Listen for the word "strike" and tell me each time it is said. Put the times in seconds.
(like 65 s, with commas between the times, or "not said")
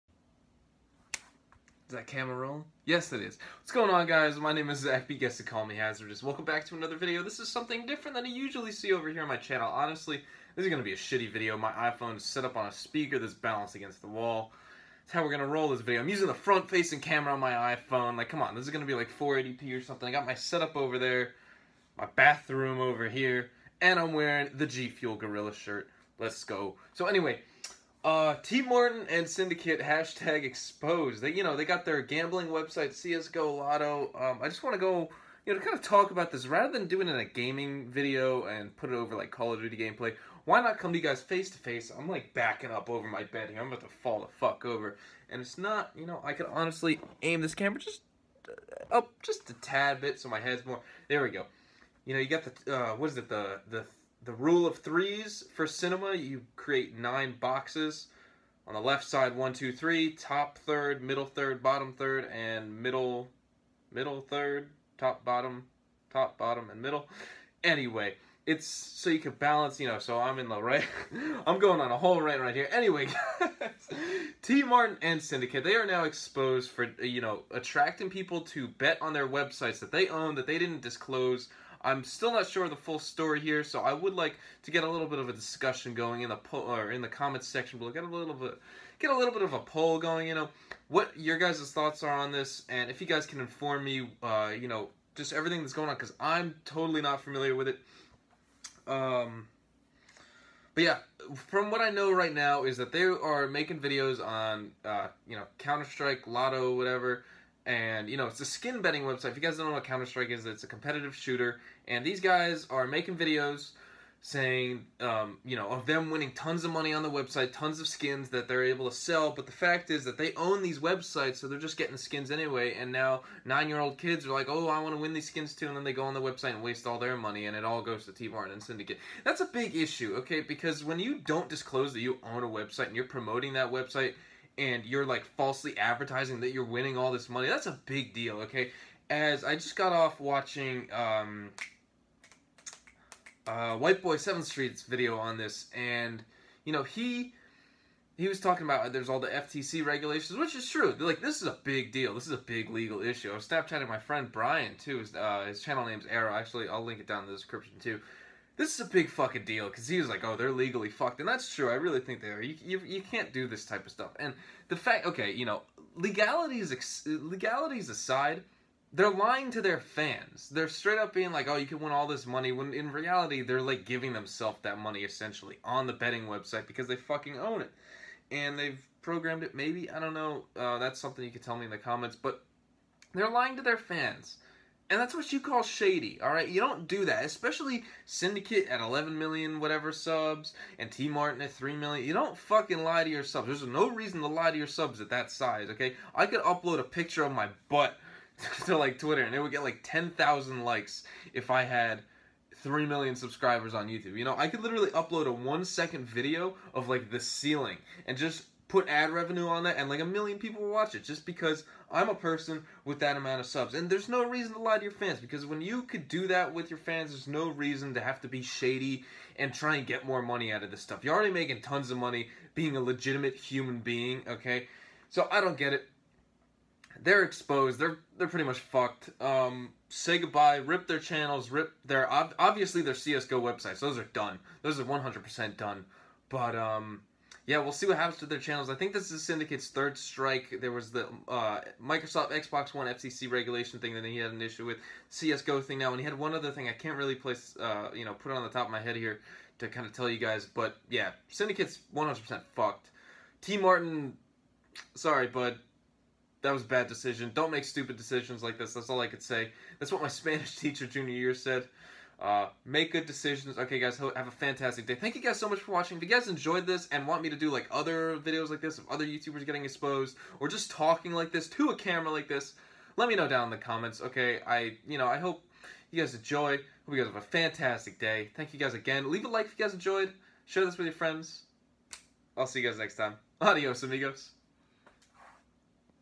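105 s, 110 s, 239 s.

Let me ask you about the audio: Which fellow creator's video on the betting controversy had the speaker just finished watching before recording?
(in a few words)
White Boy 7th Street.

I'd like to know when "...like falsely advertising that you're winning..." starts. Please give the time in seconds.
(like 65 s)
135 s.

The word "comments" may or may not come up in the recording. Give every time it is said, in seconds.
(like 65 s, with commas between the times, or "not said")
87 s, 181 s, 273 s.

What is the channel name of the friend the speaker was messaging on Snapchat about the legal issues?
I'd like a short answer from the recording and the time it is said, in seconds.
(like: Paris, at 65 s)
Arrow, at 156 s.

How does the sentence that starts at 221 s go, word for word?
You're already making tons of money being a legitimate human being, okay?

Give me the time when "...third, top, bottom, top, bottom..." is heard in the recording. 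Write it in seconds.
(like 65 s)
64 s.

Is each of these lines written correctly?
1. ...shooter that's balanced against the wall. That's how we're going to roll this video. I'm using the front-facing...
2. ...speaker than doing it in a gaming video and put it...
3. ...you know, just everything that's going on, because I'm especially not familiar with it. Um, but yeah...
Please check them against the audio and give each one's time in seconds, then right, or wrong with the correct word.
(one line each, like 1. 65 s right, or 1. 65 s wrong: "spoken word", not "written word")
1. 12 s wrong: "speaker", not "shooter"
2. 36 s wrong: "rather", not "speaker"
3. 94 s wrong: "totally", not "especially".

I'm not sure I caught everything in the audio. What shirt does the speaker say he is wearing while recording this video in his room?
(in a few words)
G Fuel Gorilla shirt.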